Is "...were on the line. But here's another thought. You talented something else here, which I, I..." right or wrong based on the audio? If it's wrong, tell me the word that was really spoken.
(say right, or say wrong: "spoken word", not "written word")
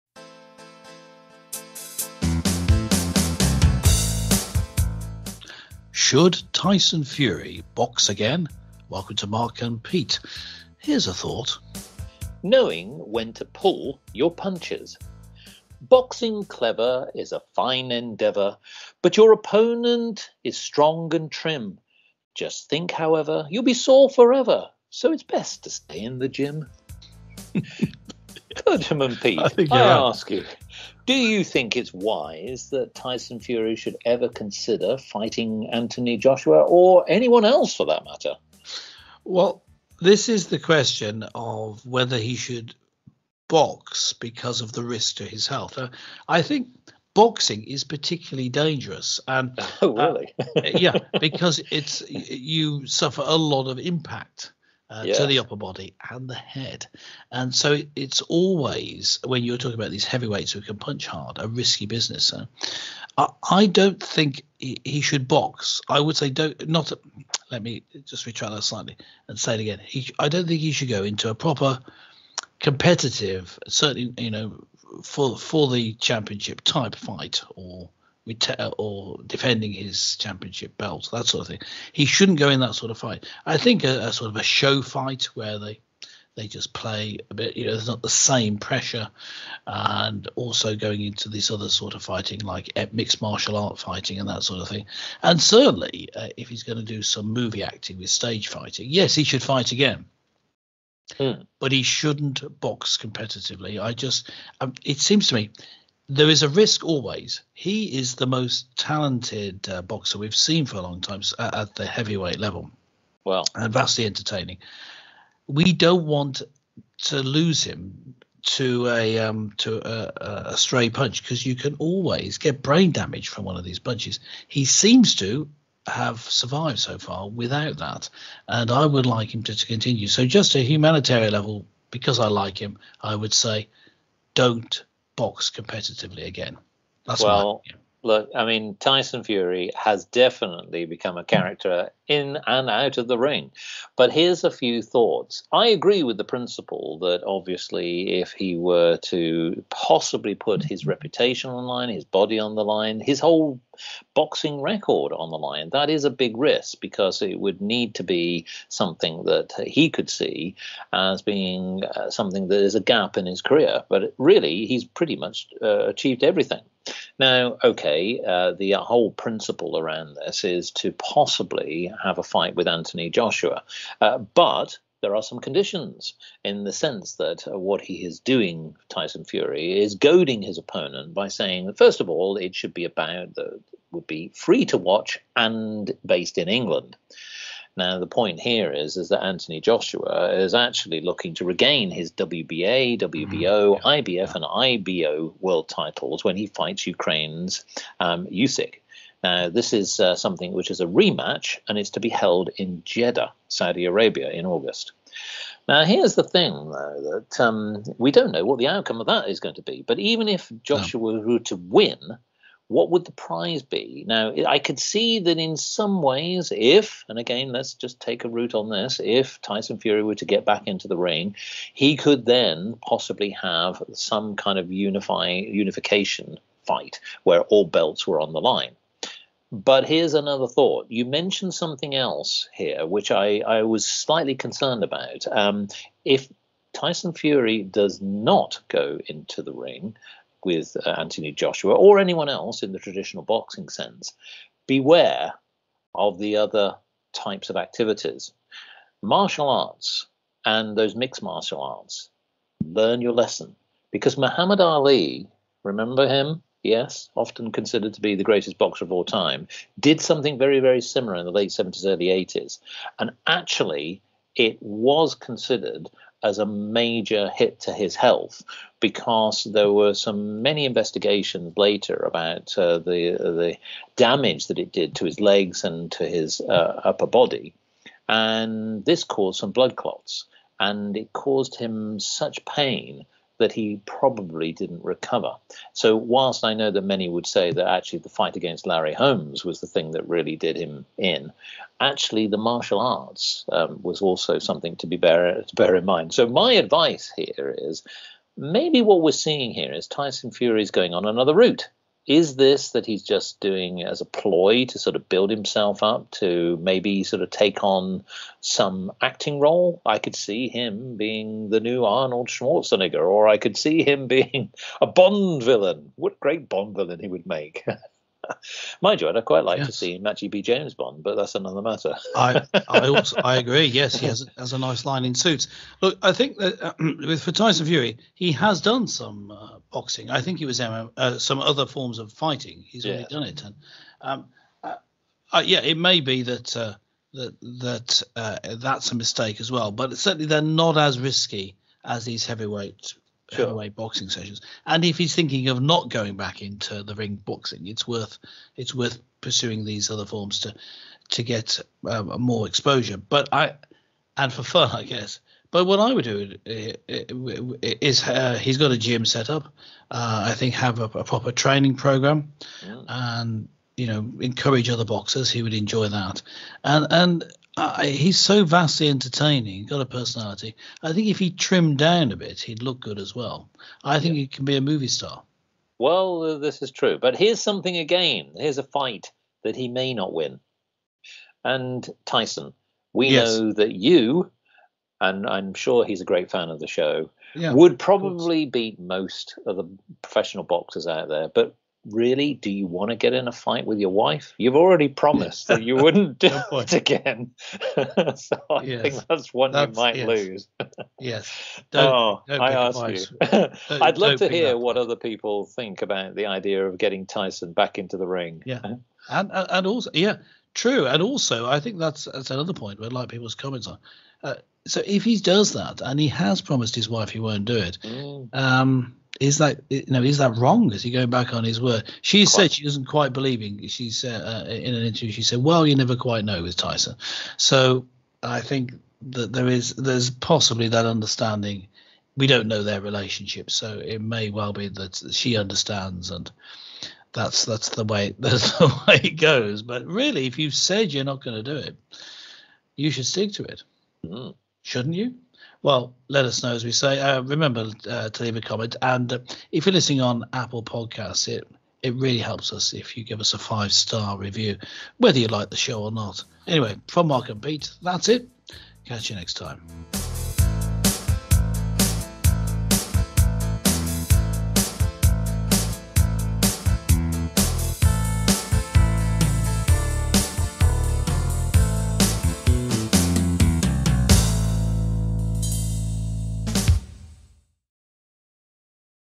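wrong: "mentioned", not "talented".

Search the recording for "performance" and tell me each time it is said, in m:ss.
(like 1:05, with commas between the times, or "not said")
not said.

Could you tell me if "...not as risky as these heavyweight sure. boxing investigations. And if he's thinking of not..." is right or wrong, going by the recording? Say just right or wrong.
wrong.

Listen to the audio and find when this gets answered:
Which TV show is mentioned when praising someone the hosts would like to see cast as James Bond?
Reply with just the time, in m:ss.
5:25.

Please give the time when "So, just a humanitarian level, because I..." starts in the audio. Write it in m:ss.
2:10.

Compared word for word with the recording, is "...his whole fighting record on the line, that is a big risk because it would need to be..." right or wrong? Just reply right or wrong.
wrong.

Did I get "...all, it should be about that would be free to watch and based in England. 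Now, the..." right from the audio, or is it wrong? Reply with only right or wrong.
right.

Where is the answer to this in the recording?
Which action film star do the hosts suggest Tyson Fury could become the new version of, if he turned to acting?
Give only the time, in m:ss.
5:11.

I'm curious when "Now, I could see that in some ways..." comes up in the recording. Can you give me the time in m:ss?
3:34.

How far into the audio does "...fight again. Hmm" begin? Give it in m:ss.
1:39.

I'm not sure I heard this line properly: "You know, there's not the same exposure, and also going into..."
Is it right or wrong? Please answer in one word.
wrong.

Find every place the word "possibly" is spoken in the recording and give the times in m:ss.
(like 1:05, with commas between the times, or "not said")
2:29, 2:50, 3:42, 7:10.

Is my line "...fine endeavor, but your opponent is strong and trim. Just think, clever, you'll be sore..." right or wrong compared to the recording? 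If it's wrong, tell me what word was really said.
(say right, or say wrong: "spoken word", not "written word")
wrong: "however", not "clever".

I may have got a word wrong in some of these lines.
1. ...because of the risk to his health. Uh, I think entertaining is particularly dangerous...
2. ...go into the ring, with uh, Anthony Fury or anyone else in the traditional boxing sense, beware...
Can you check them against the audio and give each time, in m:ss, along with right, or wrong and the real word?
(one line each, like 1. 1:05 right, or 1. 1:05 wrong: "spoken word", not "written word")
1. 0:44 wrong: "boxing", not "entertaining"
2. 3:58 wrong: "Joshua", not "Fury".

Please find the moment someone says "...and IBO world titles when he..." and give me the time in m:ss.
3:14.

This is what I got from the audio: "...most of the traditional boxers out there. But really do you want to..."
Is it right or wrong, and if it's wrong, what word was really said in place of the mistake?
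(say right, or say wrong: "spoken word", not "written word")
wrong: "professional", not "traditional".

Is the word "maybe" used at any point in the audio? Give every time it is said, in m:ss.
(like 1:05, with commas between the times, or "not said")
4:58, 5:06.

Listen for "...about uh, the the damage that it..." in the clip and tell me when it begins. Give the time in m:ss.
4:31.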